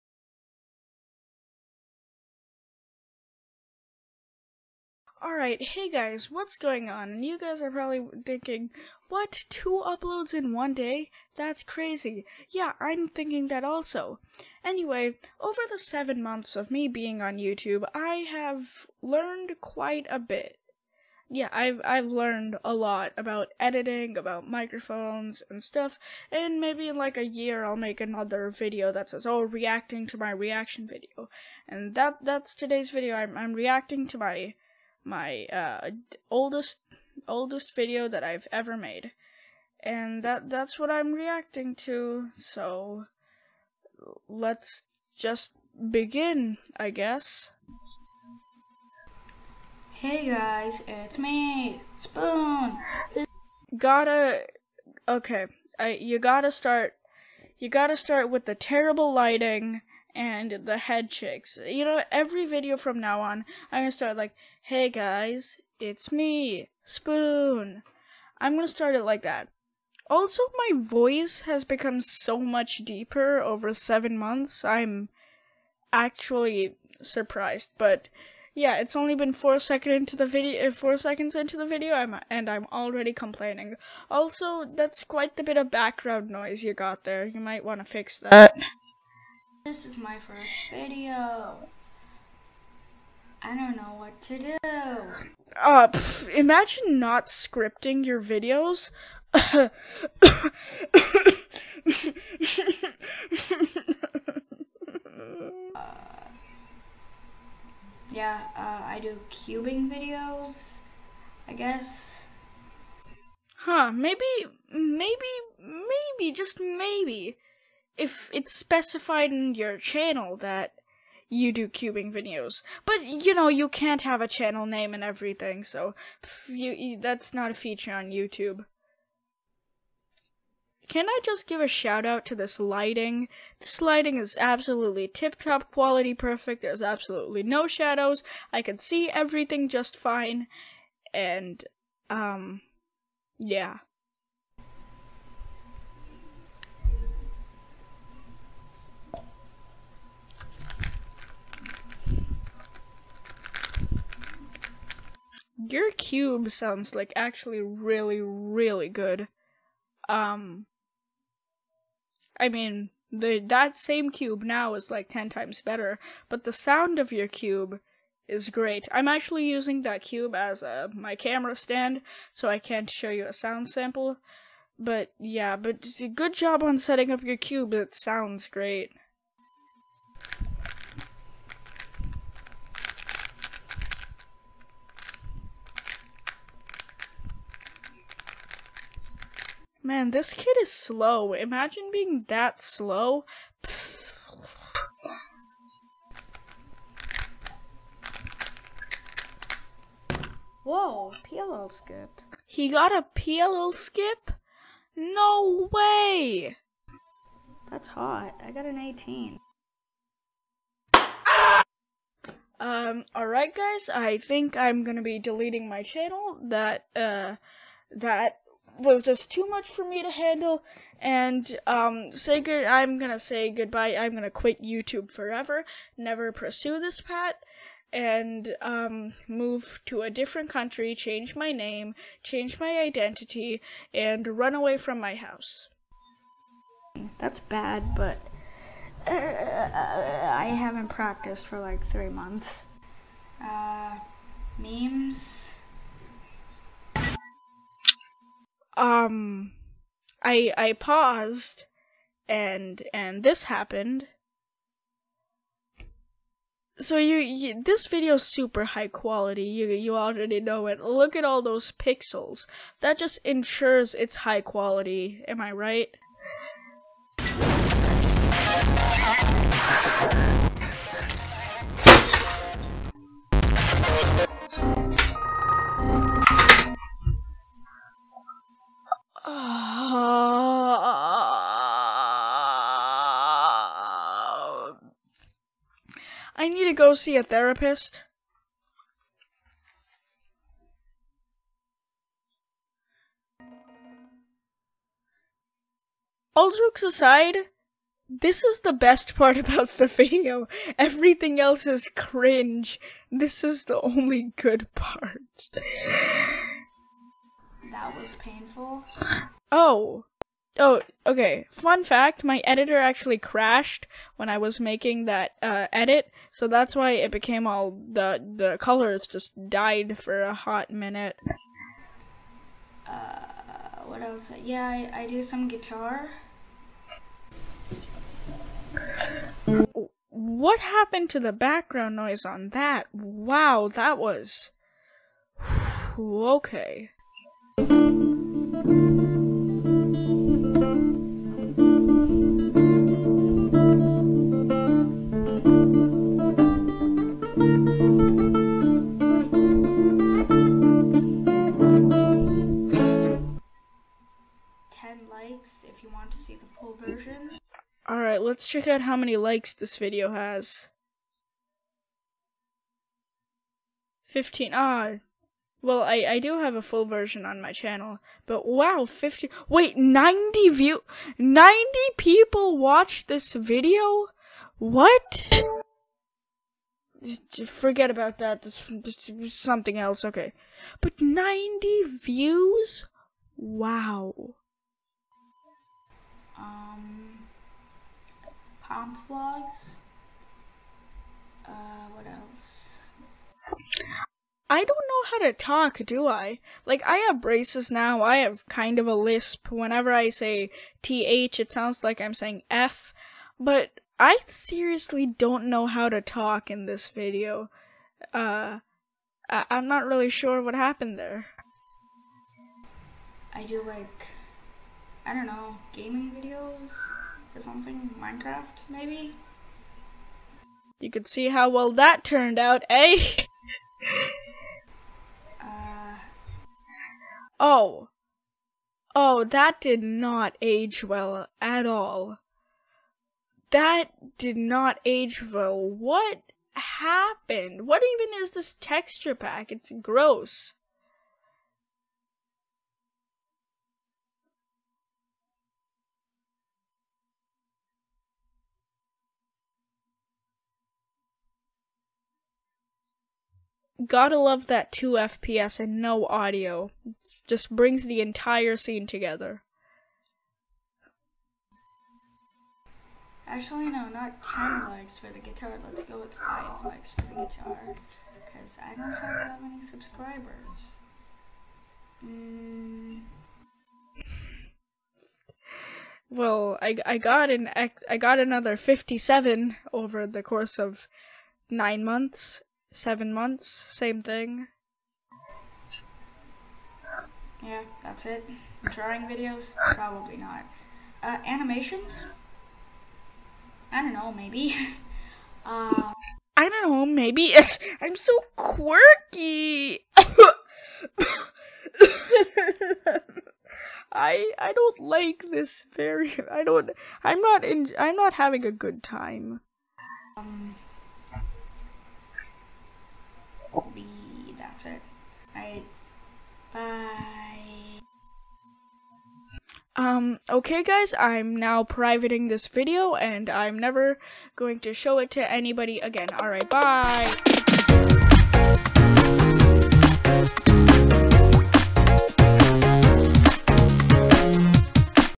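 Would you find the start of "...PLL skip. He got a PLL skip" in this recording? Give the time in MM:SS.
03:21.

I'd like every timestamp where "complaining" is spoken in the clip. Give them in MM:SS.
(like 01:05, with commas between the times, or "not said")
01:23.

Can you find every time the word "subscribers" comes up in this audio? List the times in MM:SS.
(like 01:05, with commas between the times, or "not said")
07:49.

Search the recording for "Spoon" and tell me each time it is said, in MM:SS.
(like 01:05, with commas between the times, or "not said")
00:51, 01:06.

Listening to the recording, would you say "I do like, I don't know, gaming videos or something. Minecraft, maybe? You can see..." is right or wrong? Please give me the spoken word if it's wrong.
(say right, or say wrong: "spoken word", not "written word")
right.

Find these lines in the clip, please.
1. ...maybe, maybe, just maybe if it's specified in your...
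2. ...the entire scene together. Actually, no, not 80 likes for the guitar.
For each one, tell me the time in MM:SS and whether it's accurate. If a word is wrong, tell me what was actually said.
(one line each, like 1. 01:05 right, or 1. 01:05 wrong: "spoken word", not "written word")
1. 01:54 right
2. 07:37 wrong: "10", not "80".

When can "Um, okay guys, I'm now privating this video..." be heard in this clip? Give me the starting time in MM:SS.
08:39.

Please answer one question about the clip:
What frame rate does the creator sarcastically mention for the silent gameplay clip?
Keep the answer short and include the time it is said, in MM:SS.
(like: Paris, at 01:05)
2 FPS, at 07:34.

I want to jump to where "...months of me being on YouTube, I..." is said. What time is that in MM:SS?
00:16.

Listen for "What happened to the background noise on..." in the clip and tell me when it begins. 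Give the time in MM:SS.
05:30.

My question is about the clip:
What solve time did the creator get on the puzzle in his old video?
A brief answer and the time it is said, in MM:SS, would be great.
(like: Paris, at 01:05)
18, at 03:28.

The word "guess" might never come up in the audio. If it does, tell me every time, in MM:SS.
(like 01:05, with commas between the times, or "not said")
00:46, 01:51.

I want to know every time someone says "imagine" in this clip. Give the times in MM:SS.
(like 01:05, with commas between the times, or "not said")
01:36, 03:11.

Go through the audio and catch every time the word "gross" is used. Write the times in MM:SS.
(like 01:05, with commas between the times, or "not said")
07:19.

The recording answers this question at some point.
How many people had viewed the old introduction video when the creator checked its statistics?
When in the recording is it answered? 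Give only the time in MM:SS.
06:09.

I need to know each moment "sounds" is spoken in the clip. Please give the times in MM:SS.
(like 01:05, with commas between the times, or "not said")
02:36, 02:46, 02:53, 02:57, 06:41.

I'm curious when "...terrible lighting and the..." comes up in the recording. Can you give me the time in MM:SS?
00:58.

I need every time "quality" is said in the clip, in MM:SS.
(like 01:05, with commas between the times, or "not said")
02:15, 04:18, 04:24.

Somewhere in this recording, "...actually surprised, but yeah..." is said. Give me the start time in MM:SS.
01:15.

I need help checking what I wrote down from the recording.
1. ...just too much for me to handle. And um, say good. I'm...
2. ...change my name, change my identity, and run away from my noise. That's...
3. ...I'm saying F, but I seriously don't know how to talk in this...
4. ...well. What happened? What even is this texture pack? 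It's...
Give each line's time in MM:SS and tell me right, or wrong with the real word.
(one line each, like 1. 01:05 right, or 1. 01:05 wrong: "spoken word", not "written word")
1. 03:39 right
2. 03:50 wrong: "house", not "noise"
3. 06:42 right
4. 07:15 right.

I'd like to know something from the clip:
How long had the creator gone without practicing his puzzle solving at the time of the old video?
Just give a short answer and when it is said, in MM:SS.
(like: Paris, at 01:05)
three months, at 04:01.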